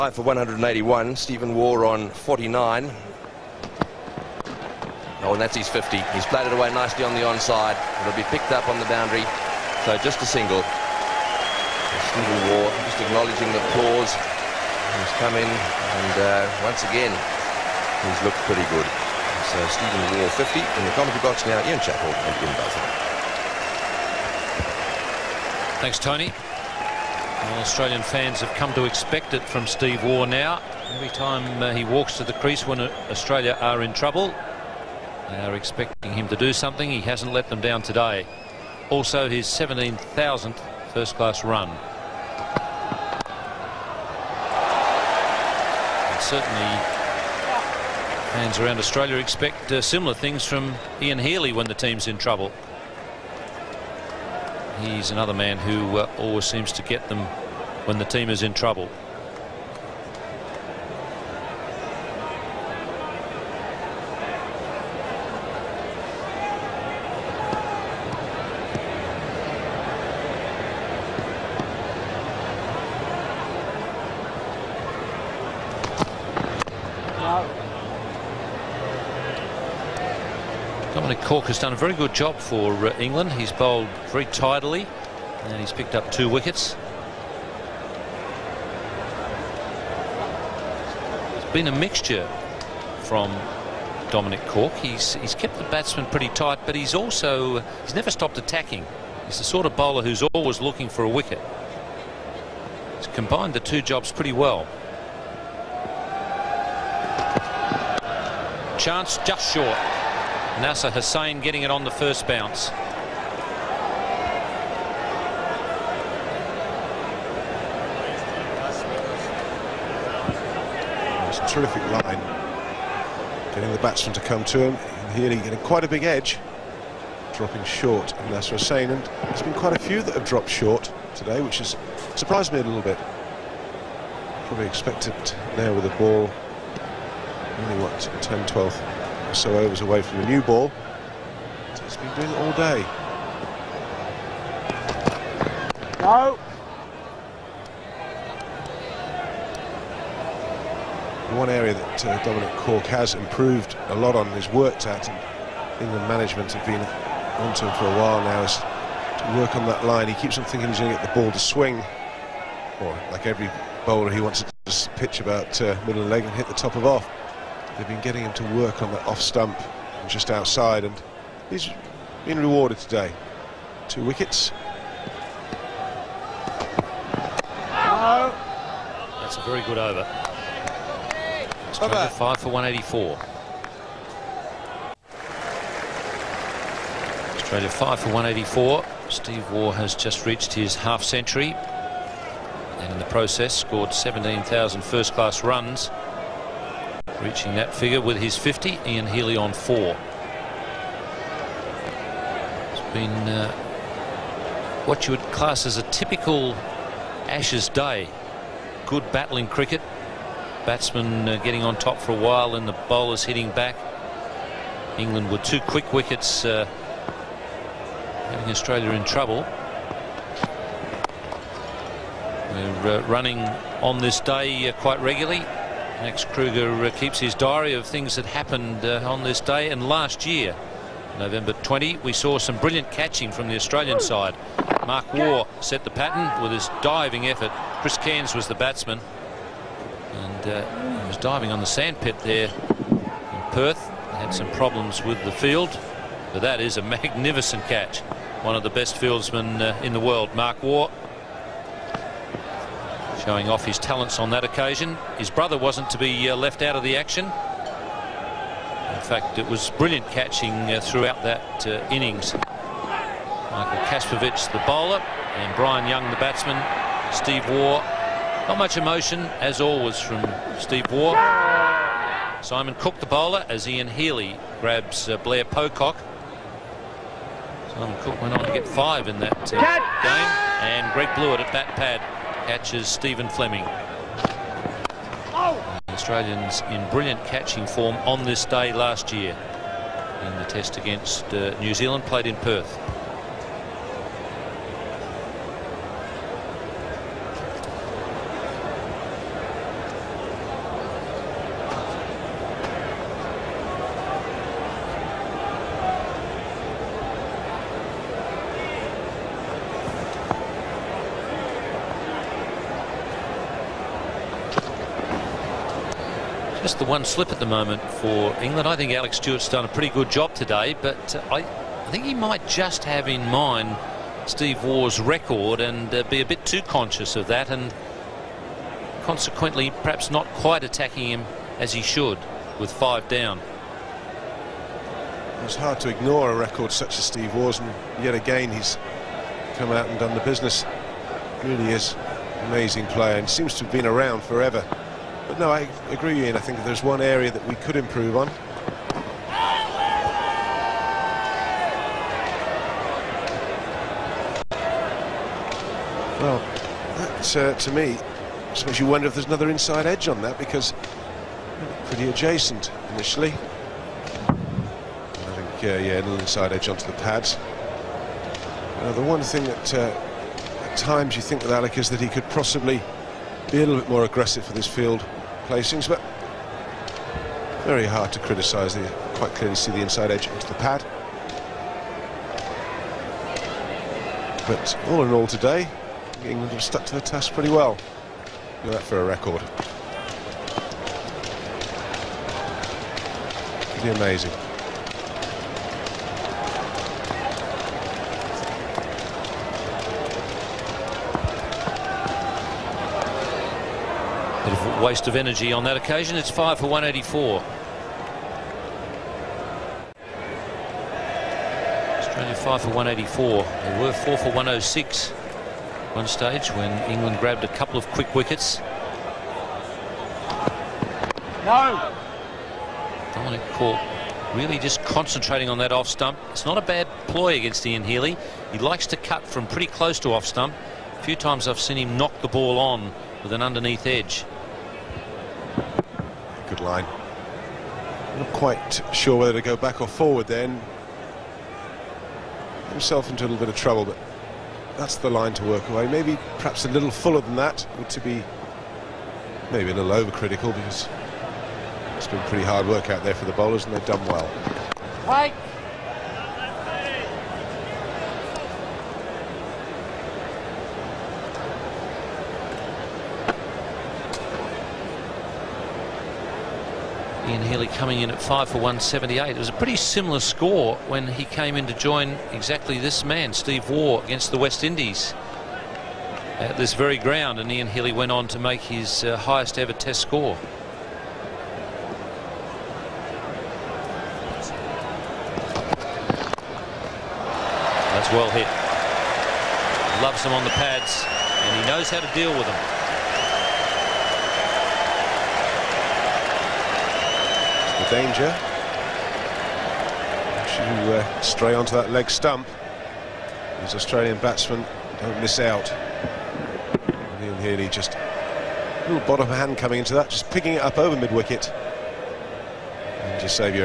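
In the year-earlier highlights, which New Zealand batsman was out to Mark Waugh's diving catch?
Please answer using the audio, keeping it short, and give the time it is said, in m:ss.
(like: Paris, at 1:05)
Chris Cairns, at 3:57.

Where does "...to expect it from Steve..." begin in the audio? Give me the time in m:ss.
0:28.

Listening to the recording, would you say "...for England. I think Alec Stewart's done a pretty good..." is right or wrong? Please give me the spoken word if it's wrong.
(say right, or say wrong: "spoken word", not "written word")
right.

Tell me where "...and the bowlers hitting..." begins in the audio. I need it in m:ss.
3:32.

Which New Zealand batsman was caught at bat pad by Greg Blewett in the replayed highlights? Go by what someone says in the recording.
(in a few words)
Stephen Fleming.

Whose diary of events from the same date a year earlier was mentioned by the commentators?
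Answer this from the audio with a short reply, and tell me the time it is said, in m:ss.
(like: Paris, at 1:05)
Max Kruger, at 3:46.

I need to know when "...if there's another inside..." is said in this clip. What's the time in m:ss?
5:59.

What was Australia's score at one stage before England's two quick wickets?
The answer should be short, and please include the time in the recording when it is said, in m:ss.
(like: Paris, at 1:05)
4 for 106, at 6:53.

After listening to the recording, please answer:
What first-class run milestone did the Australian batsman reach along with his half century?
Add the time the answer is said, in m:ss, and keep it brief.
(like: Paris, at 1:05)
17,000, at 0:39.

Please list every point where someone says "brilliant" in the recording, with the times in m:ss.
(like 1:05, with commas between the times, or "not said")
3:52, 4:19, 4:46.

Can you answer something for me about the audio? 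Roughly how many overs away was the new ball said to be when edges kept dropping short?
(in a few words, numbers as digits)
10 to 12.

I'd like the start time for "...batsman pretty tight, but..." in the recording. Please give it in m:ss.
1:35.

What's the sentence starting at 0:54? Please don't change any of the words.
He's another man who uh, always seems to get them when the team is in trouble.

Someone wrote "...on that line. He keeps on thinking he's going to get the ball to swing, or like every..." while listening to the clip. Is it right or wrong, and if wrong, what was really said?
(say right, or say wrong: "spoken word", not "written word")
right.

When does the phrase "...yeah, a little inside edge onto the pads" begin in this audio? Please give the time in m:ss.
6:05.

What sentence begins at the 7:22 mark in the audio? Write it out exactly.
Himself into a little bit of trouble, but that's the line to work away.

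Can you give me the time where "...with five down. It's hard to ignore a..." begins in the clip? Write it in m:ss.
5:32.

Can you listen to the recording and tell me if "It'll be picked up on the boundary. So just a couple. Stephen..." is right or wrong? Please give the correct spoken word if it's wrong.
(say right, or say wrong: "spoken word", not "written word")
wrong: "single", not "couple".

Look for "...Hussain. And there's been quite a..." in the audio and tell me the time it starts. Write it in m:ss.
2:08.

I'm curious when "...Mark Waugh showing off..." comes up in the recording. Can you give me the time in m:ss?
4:10.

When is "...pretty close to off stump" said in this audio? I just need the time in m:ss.
7:09.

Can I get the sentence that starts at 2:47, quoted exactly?
They've been getting him to work on the off stump just outside, and he's been rewarded today.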